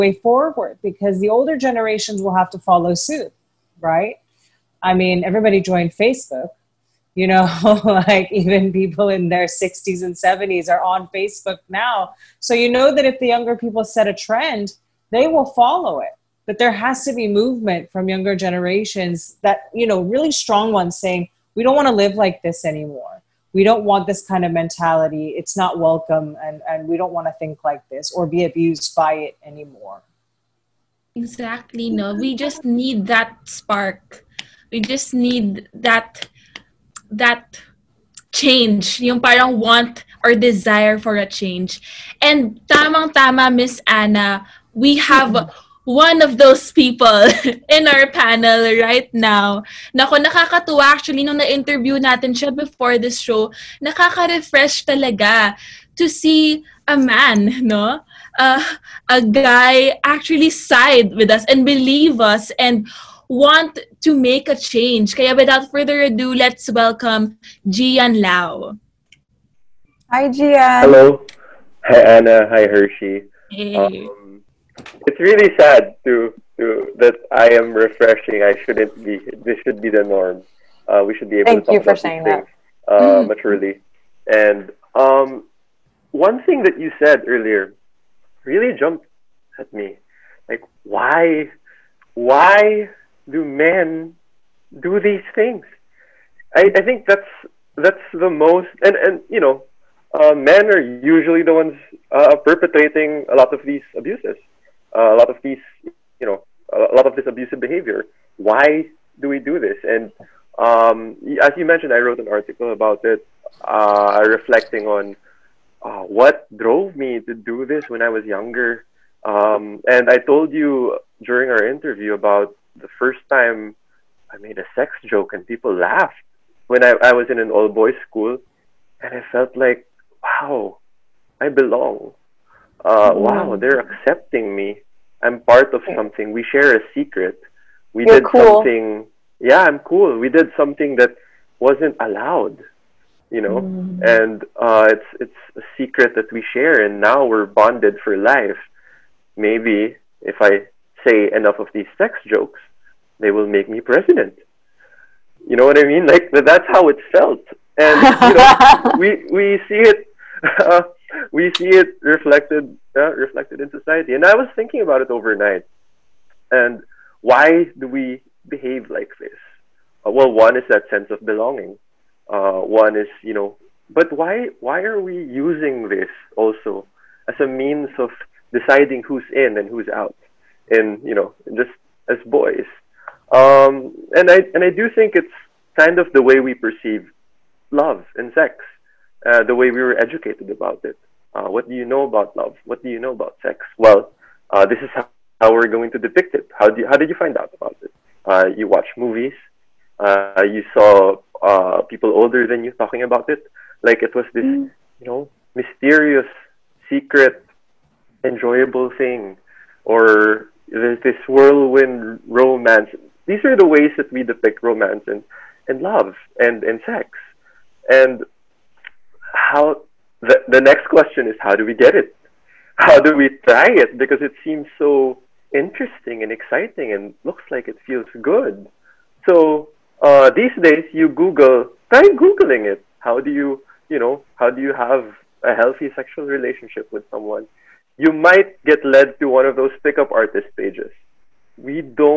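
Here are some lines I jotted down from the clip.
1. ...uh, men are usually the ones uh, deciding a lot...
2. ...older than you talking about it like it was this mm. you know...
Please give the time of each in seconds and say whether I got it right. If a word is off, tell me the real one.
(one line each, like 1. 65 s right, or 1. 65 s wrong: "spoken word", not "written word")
1. 100 s wrong: "perpetrating", not "deciding"
2. 202 s right.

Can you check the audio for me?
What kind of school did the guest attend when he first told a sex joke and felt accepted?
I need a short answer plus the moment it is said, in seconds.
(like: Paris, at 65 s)
all boys school, at 127 s.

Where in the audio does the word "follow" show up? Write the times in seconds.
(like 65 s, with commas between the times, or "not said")
2 s, 15 s.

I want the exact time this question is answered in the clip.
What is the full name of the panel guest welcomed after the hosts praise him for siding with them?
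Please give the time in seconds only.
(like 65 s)
67 s.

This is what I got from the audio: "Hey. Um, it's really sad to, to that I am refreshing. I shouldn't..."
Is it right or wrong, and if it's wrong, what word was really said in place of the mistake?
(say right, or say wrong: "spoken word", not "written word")
right.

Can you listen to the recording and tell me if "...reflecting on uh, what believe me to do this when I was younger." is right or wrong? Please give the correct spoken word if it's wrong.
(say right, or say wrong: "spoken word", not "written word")
wrong: "drove", not "believe".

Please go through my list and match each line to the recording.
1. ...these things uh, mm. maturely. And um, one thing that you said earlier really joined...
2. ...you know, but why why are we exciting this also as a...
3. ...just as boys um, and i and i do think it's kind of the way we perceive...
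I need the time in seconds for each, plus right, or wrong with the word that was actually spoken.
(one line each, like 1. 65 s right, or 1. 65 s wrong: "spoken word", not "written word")
1. 82 s wrong: "jumped", not "joined"
2. 173 s wrong: "using", not "exciting"
3. 181 s right.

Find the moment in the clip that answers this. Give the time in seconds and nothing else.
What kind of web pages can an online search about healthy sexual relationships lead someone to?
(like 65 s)
239 s.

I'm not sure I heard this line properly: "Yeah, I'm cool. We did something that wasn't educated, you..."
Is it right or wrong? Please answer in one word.
wrong.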